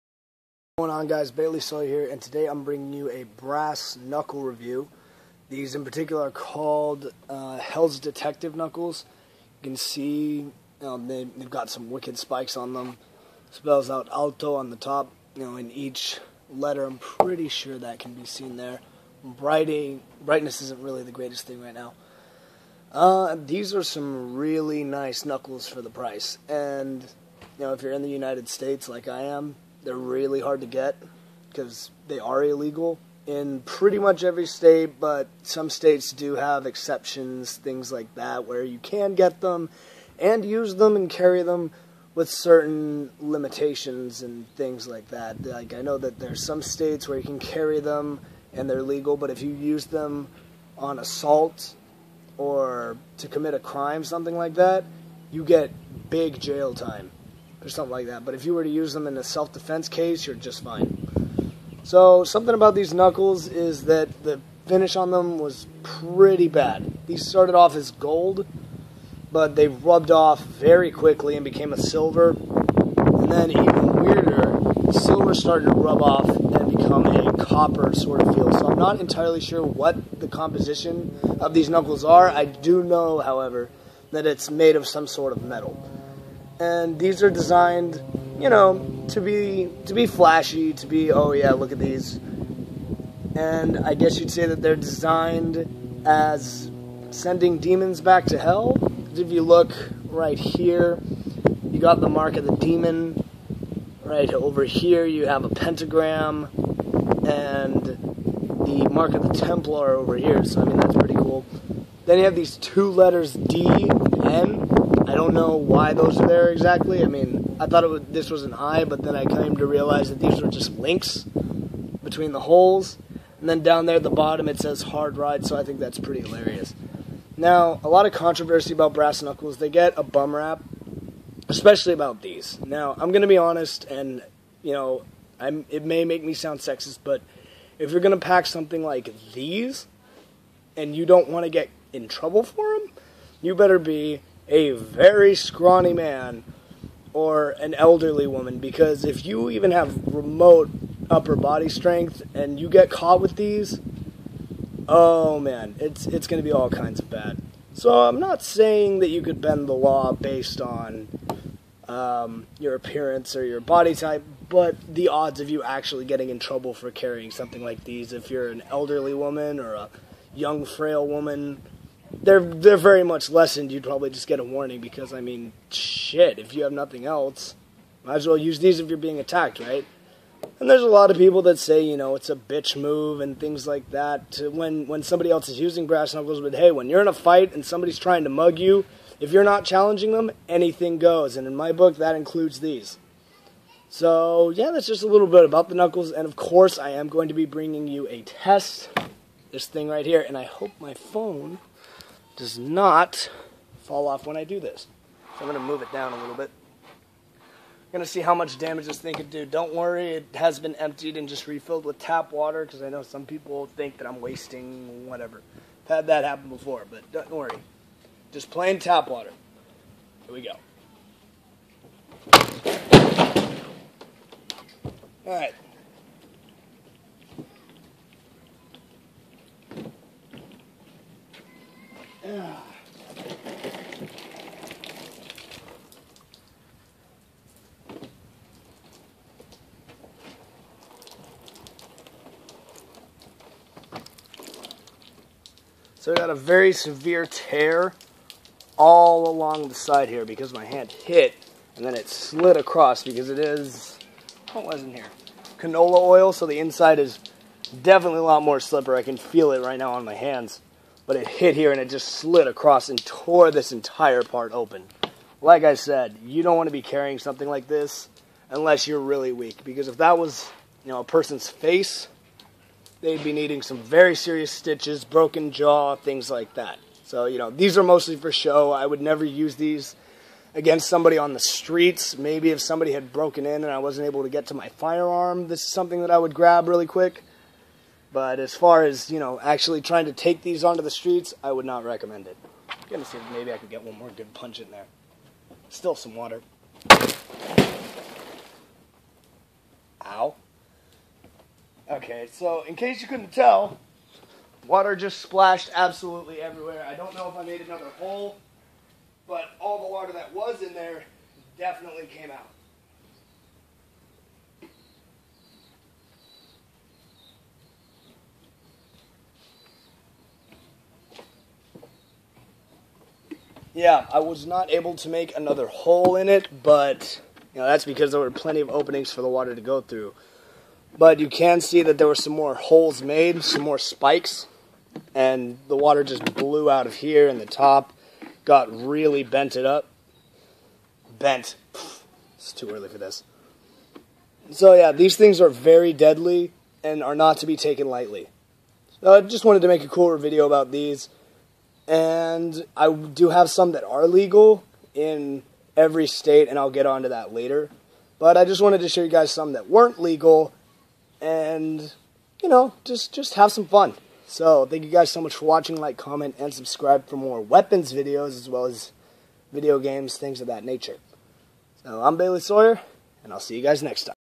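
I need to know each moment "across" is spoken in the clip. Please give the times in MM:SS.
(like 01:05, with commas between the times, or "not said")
04:12, 04:22.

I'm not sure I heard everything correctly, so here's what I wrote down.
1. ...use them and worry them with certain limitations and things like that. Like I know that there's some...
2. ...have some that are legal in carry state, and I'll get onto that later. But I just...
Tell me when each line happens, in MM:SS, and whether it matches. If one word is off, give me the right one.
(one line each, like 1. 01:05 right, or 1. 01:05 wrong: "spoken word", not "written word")
1. 00:40 wrong: "carry", not "worry"
2. 05:53 wrong: "every", not "carry".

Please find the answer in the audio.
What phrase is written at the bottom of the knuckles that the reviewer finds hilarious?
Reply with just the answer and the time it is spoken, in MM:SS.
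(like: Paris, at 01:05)
Hard ride, at 02:04.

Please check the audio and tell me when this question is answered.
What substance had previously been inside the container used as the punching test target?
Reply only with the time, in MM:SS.
04:15.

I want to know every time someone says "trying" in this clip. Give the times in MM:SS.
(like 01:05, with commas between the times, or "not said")
03:07, 04:49.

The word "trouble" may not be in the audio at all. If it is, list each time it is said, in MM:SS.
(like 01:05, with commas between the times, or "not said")
02:22, 02:46.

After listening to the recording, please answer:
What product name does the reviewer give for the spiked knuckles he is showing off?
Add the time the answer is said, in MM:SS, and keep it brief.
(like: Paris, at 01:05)
Hell's Detective Knuckles, at 00:07.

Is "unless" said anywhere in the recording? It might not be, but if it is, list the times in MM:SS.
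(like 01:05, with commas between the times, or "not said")
04:28.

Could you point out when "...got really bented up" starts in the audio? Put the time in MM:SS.
05:38.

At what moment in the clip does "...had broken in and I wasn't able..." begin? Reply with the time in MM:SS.
04:42.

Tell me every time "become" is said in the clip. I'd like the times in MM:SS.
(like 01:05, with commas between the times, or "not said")
01:16.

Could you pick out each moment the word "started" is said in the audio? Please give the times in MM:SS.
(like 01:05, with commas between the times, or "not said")
01:07, 01:15.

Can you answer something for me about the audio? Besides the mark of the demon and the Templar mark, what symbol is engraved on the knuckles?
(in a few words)
Pentagram.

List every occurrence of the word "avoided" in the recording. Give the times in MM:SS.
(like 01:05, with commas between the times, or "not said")
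not said.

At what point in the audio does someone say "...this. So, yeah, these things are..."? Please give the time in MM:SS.
05:42.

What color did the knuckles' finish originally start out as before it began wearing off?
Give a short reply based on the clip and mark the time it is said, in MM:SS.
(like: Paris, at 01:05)
Gold, at 01:07.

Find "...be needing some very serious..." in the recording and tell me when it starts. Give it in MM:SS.
04:33.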